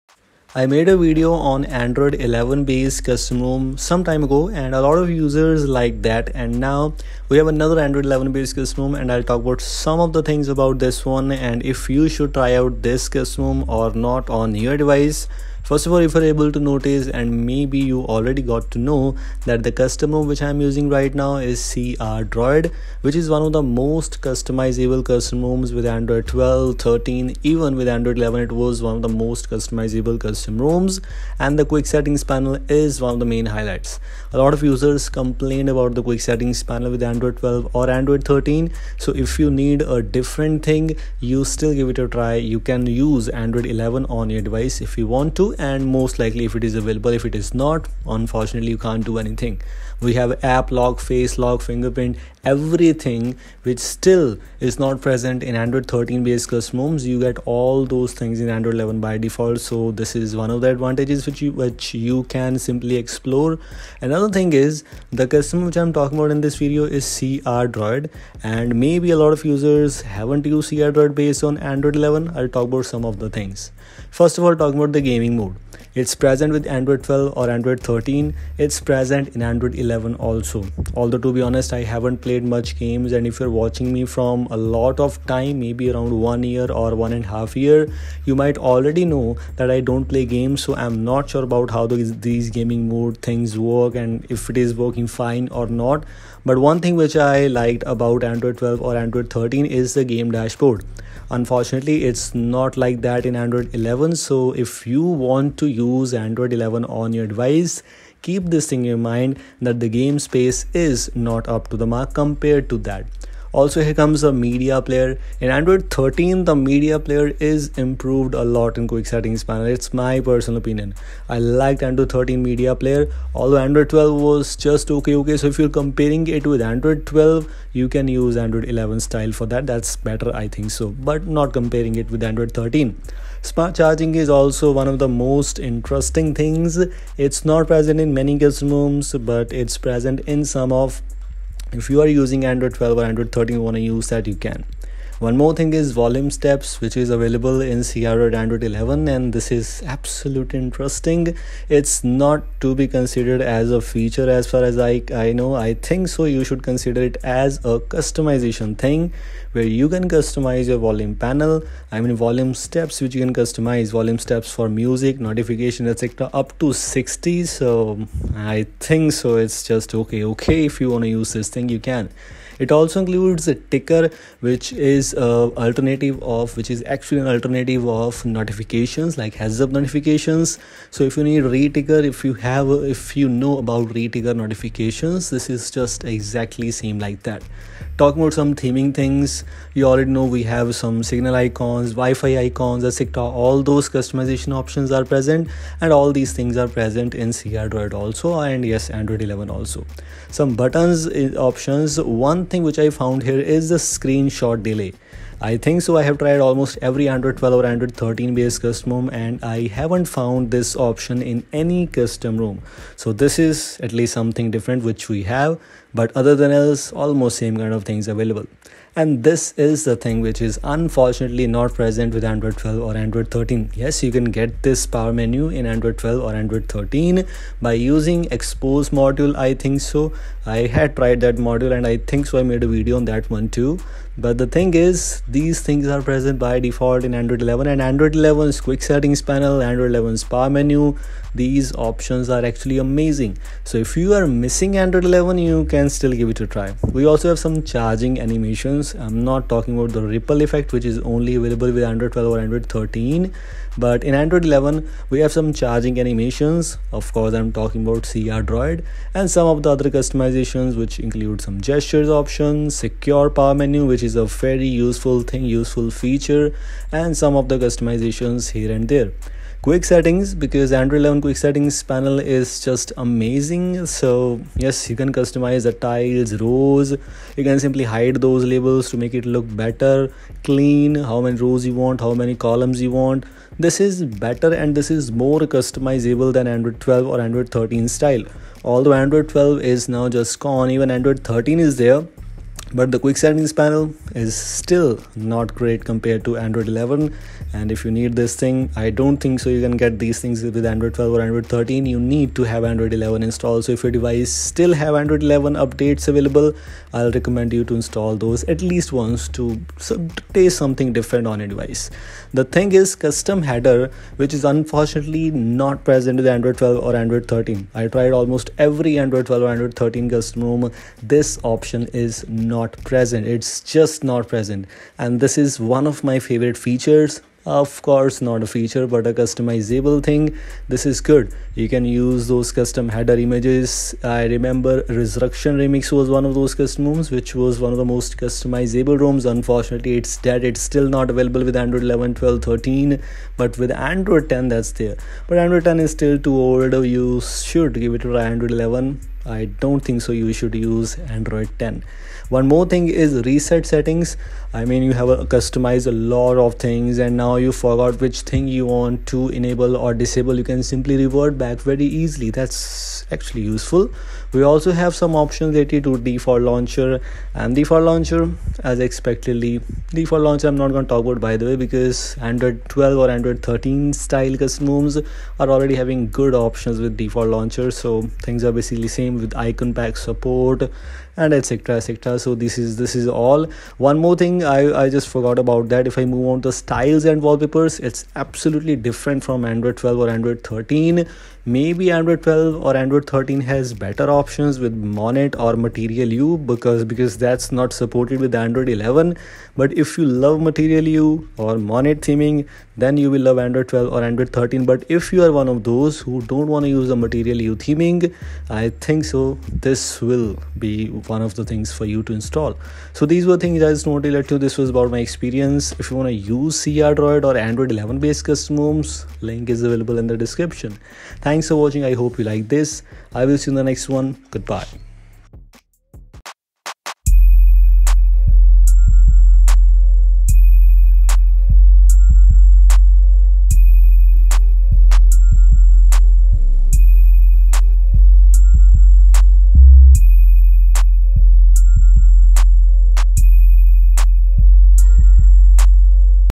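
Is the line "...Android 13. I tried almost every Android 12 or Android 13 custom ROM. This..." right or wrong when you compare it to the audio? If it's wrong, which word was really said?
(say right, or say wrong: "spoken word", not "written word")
right.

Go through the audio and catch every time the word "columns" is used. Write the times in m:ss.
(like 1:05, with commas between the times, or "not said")
4:42.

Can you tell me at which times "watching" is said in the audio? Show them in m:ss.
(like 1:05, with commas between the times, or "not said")
1:23, 7:01.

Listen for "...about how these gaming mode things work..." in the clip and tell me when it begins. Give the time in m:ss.
1:31.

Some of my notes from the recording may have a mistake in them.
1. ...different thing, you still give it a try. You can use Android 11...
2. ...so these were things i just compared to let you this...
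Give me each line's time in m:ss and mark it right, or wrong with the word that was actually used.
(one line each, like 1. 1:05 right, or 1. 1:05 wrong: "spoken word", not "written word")
1. 0:40 right
2. 6:53 wrong: "wanted", not "compared".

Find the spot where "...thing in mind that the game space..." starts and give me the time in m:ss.
1:48.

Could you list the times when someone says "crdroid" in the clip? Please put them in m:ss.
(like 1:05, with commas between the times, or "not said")
1:10, 2:27, 4:18.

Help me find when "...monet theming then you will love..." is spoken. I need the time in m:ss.
6:41.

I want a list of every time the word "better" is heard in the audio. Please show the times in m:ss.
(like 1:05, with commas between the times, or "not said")
2:09, 4:39, 4:44, 6:33.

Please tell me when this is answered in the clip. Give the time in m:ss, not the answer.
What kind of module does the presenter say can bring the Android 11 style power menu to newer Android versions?
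3:48.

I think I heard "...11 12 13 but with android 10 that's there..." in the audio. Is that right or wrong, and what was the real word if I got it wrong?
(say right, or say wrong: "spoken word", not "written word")
right.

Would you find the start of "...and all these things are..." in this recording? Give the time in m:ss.
3:15.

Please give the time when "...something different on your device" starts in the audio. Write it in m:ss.
5:10.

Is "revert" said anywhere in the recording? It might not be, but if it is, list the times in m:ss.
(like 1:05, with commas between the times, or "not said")
6:00.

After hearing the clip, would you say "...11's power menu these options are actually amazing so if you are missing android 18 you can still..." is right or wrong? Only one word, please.
wrong.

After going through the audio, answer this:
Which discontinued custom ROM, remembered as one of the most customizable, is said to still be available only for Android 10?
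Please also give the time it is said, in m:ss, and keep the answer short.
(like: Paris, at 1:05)
Resurrection Remix, at 5:34.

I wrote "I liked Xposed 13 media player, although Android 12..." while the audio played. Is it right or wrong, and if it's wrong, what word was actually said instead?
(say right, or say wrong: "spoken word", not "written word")
wrong: "Android", not "Xposed".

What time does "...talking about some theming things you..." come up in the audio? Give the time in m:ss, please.
3:08.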